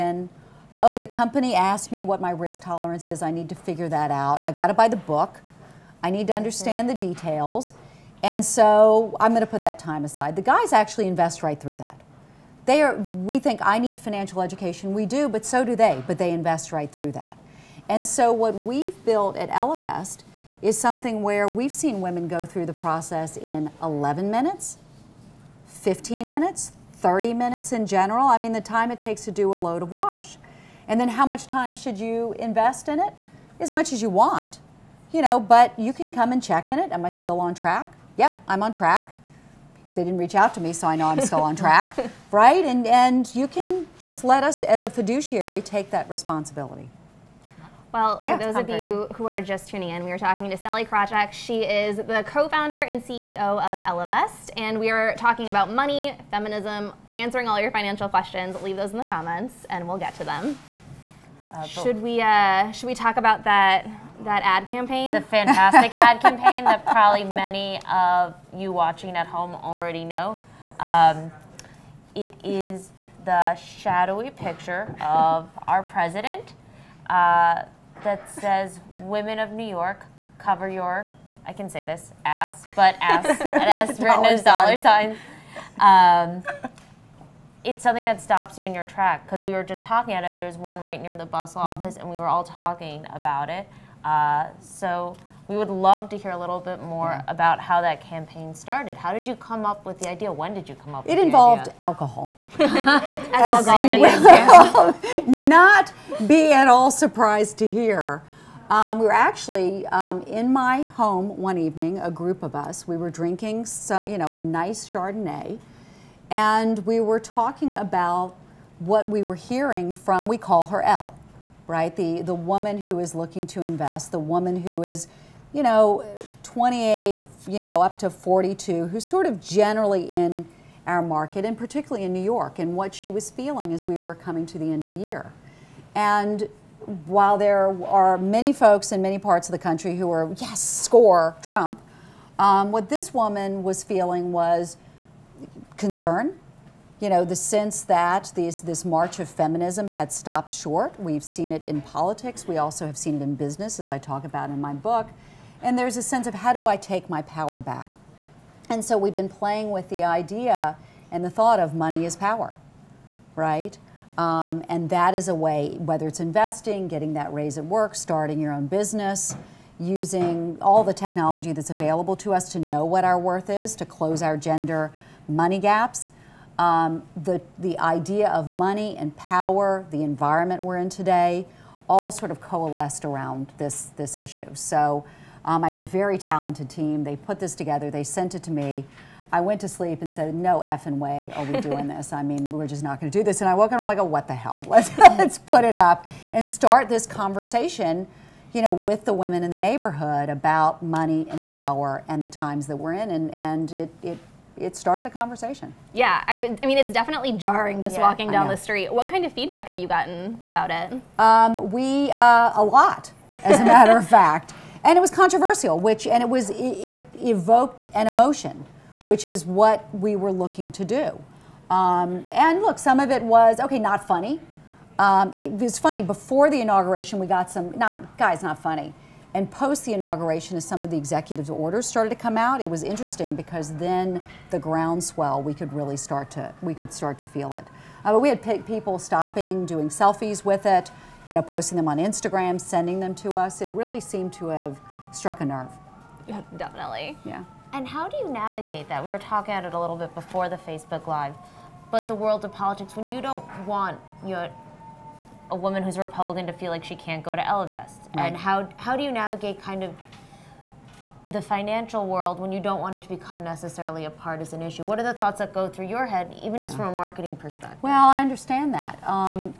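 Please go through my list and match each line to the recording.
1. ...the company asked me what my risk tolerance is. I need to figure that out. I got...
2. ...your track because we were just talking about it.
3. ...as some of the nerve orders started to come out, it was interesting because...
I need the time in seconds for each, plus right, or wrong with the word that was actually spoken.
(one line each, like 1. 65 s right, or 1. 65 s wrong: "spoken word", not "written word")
1. 0 s right
2. 88 s right
3. 230 s wrong: "executive", not "nerve".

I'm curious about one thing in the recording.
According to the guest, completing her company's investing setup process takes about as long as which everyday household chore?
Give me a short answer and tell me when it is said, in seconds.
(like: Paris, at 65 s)
a load of wash, at 29 s.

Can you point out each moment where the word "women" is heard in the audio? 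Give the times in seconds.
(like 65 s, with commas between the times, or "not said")
22 s, 78 s, 199 s.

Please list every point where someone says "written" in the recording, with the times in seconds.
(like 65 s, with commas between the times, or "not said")
84 s.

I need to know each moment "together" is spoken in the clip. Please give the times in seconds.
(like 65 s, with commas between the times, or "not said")
187 s.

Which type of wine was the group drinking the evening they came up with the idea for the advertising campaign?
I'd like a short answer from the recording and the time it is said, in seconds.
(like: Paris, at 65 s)
Chardonnay, at 114 s.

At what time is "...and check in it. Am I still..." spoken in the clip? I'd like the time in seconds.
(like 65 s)
36 s.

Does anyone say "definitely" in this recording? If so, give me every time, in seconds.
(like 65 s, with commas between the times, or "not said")
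206 s, 246 s.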